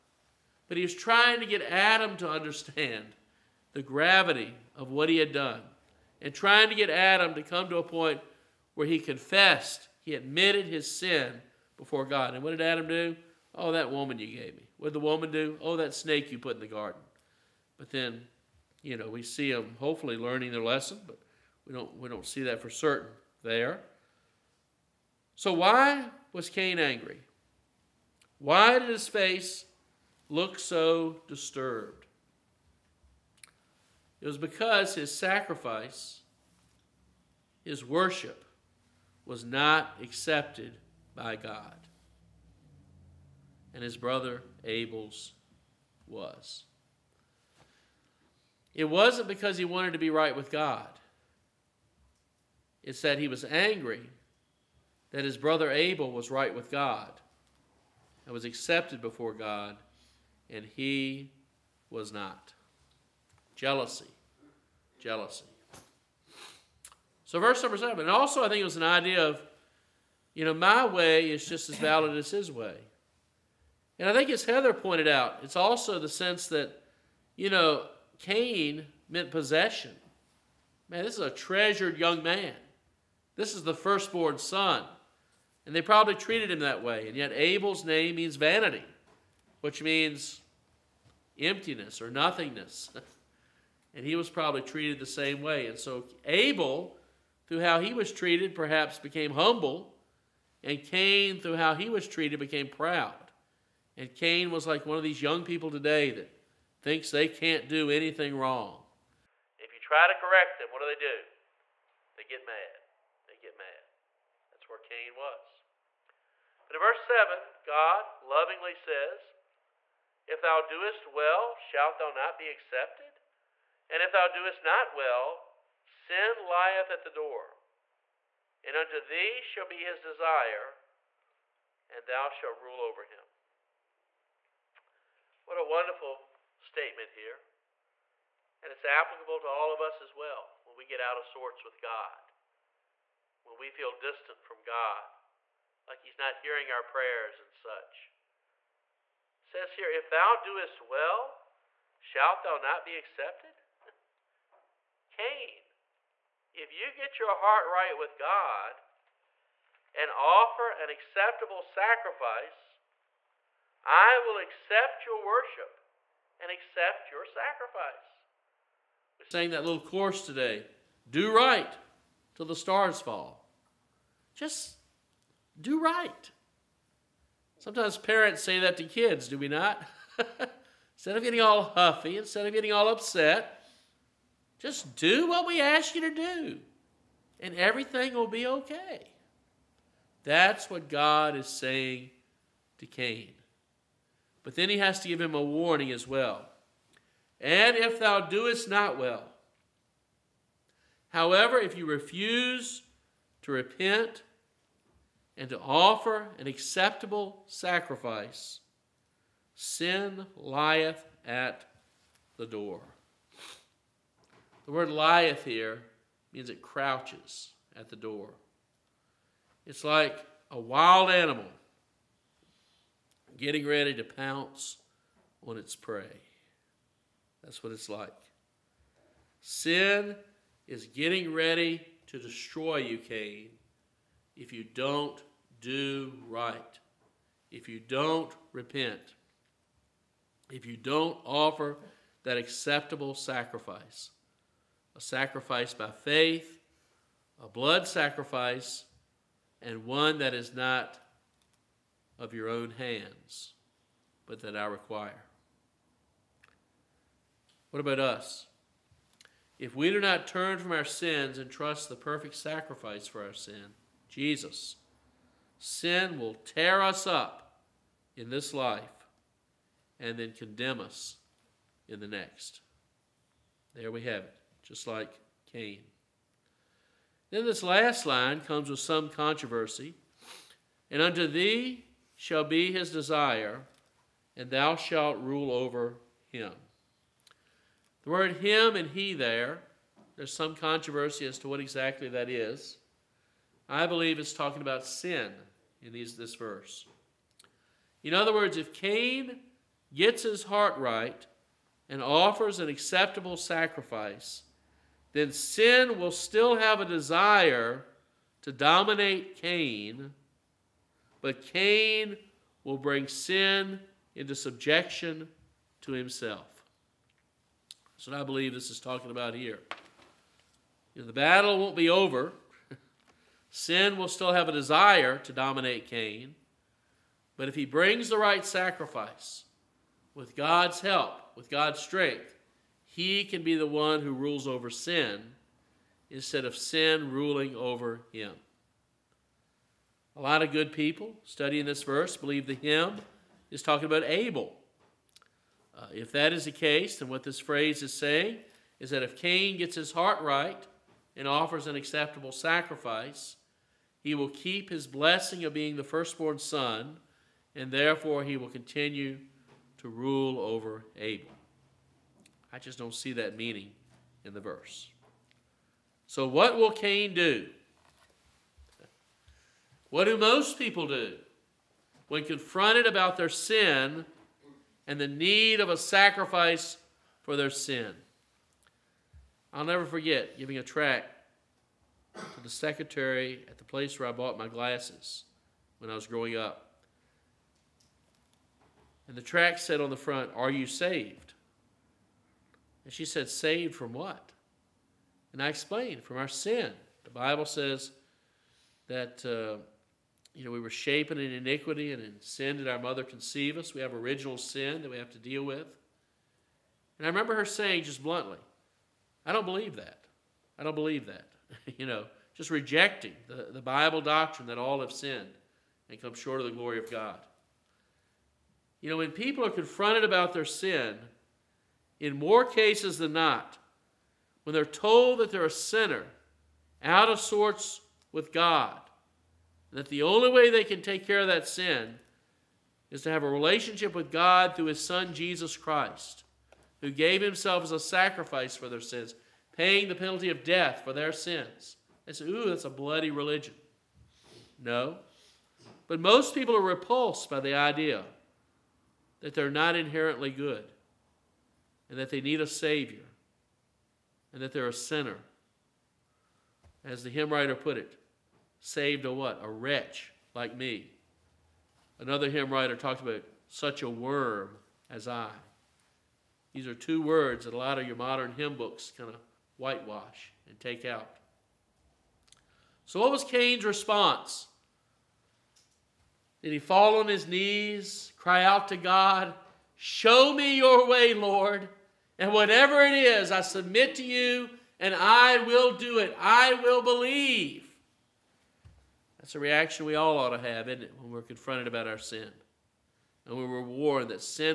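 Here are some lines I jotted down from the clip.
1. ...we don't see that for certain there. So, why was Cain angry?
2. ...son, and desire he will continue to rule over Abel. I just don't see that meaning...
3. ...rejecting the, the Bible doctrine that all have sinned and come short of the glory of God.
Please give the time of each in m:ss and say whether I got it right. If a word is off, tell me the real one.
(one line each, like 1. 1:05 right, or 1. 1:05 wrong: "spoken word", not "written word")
1. 0:21 right
2. 5:56 wrong: "therefore", not "desire"
3. 6:52 right.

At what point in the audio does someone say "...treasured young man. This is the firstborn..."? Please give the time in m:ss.
1:21.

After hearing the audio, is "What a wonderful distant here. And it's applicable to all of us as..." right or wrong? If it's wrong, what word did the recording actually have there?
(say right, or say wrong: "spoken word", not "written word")
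wrong: "statement", not "distant".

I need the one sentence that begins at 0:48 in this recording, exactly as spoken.
It wasn't because he wanted to be right with God.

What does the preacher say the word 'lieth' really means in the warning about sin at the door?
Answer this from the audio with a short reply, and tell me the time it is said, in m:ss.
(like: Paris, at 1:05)
Crouches, at 3:36.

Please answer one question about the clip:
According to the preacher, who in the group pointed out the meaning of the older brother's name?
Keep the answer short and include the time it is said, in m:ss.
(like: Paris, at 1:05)
Heather, at 1:14.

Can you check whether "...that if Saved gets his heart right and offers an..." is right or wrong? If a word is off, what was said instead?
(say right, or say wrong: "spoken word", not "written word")
wrong: "Cain", not "Saved".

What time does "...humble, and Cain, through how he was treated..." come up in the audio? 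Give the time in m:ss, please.
1:39.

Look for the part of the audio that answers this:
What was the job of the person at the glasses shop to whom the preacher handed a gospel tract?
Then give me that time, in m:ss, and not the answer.
6:22.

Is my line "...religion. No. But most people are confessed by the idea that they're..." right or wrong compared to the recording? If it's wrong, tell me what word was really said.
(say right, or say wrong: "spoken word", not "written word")
wrong: "repulsed", not "confessed".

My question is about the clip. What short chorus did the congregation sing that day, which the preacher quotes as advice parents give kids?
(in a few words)
Do right till the stars fall.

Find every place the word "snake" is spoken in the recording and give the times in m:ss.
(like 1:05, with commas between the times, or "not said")
0:15.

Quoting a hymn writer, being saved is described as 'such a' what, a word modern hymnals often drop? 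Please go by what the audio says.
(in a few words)
Worm.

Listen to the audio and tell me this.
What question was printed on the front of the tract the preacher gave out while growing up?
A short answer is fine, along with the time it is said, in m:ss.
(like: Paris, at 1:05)
Are you saved?, at 6:30.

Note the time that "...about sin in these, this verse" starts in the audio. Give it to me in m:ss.
4:54.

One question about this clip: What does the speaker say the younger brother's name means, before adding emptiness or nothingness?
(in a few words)
Vanity.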